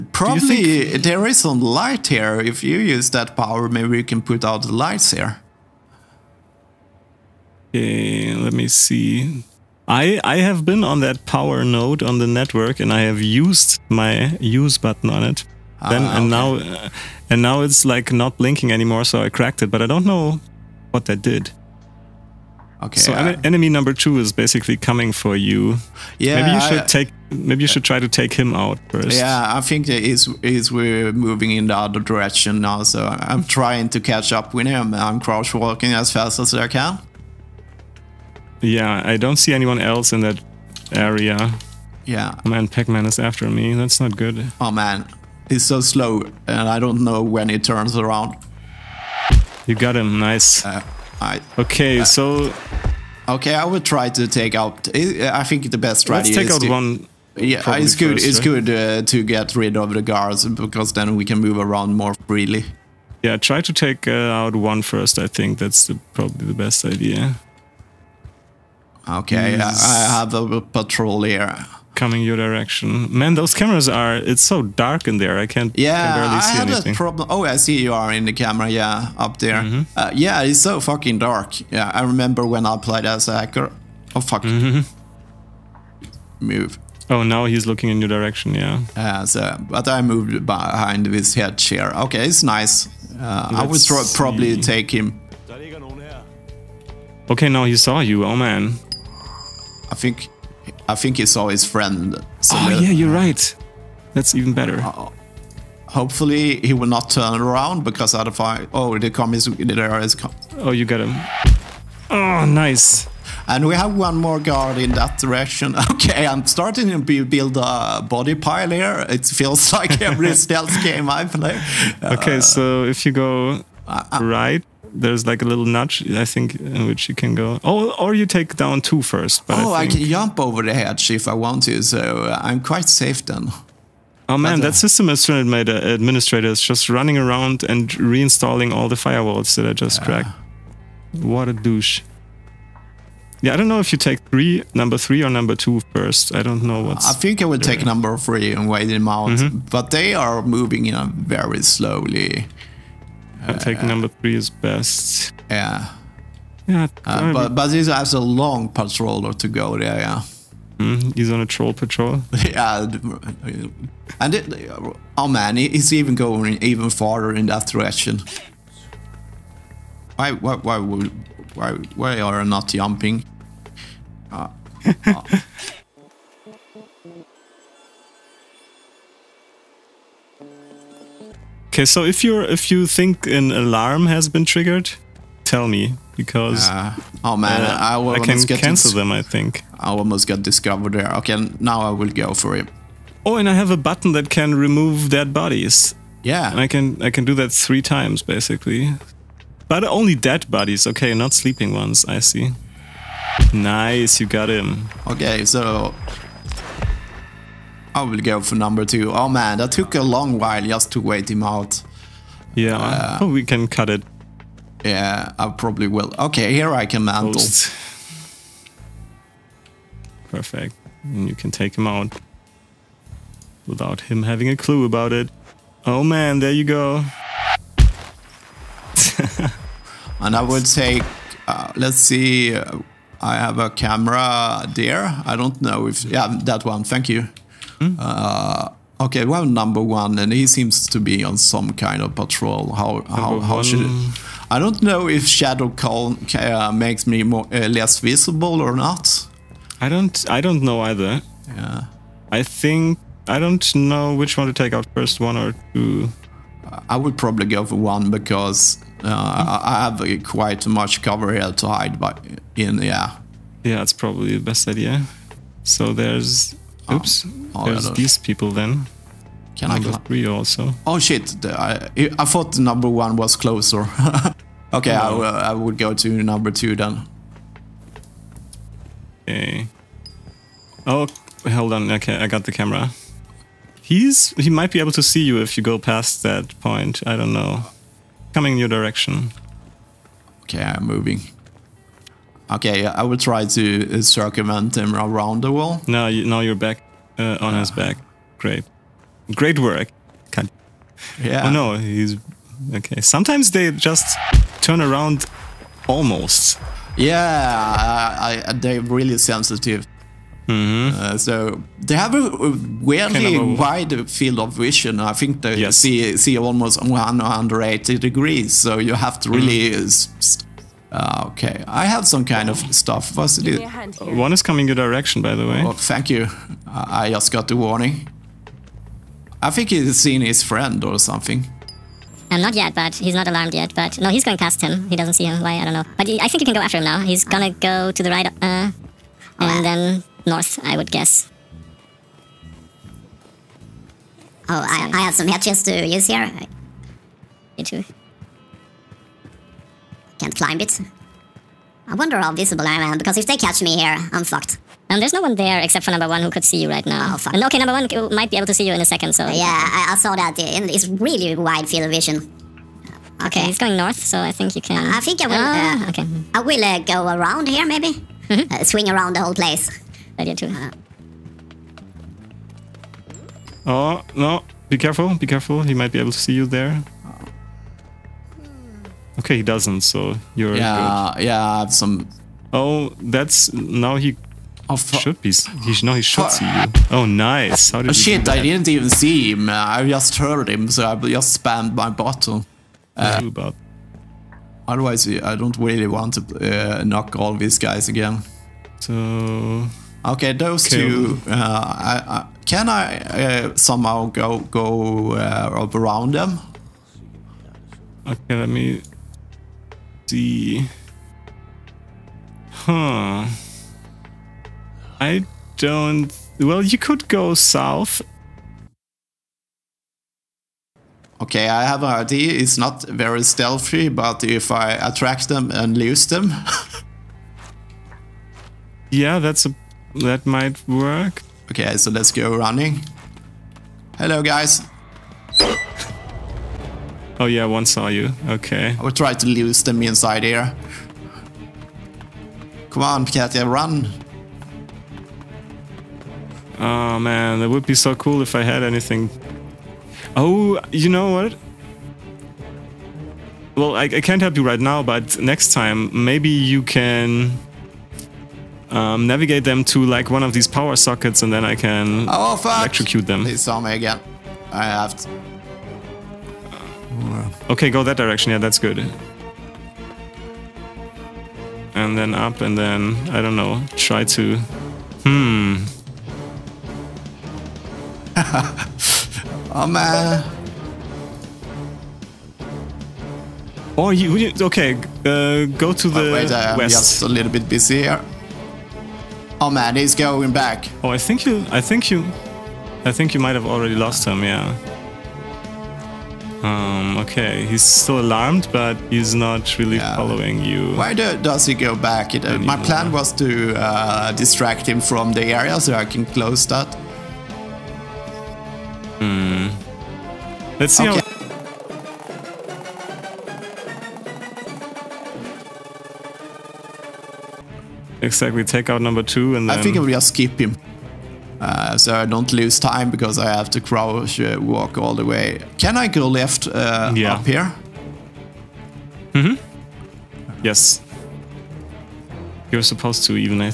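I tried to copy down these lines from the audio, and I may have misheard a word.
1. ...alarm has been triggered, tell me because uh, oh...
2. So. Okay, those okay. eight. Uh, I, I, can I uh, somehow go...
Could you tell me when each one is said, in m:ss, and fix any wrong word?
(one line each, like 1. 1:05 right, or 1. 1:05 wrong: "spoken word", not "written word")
1. 3:03 right
2. 6:38 wrong: "two", not "eight".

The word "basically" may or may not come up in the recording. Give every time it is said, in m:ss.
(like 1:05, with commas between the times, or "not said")
0:24, 3:18.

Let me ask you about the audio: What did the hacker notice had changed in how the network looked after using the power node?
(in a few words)
Not blinking anymore.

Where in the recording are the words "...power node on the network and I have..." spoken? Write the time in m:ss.
0:11.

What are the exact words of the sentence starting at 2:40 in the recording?
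Mm, he's on a troll patrol.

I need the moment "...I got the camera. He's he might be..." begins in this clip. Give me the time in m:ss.
4:42.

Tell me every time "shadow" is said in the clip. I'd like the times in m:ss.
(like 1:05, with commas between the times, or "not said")
4:05.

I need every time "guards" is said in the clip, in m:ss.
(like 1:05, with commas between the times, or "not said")
1:00, 1:54.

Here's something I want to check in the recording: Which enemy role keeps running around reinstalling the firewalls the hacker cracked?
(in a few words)
System administrator.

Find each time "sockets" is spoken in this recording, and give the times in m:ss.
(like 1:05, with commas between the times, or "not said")
7:40.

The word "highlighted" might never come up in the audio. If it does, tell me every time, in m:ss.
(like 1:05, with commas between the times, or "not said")
not said.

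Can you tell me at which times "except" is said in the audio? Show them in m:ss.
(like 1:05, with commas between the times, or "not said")
5:55.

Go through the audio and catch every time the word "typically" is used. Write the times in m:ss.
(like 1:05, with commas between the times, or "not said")
not said.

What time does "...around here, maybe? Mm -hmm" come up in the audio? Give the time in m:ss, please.
6:07.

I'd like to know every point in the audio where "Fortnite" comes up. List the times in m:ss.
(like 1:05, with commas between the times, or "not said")
not said.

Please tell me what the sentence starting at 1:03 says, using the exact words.
Yeah, try to take uh, out one first.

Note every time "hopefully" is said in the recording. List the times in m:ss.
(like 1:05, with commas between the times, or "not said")
1:45.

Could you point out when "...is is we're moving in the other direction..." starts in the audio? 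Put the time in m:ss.
0:29.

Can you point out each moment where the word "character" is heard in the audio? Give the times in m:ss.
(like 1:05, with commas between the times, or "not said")
not said.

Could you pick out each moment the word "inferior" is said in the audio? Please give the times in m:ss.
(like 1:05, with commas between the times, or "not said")
not said.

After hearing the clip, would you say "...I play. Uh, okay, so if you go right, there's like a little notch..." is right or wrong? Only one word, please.
right.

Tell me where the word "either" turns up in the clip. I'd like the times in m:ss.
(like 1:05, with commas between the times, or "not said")
4:10.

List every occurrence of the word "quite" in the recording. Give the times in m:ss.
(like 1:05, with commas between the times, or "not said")
2:12, 4:20.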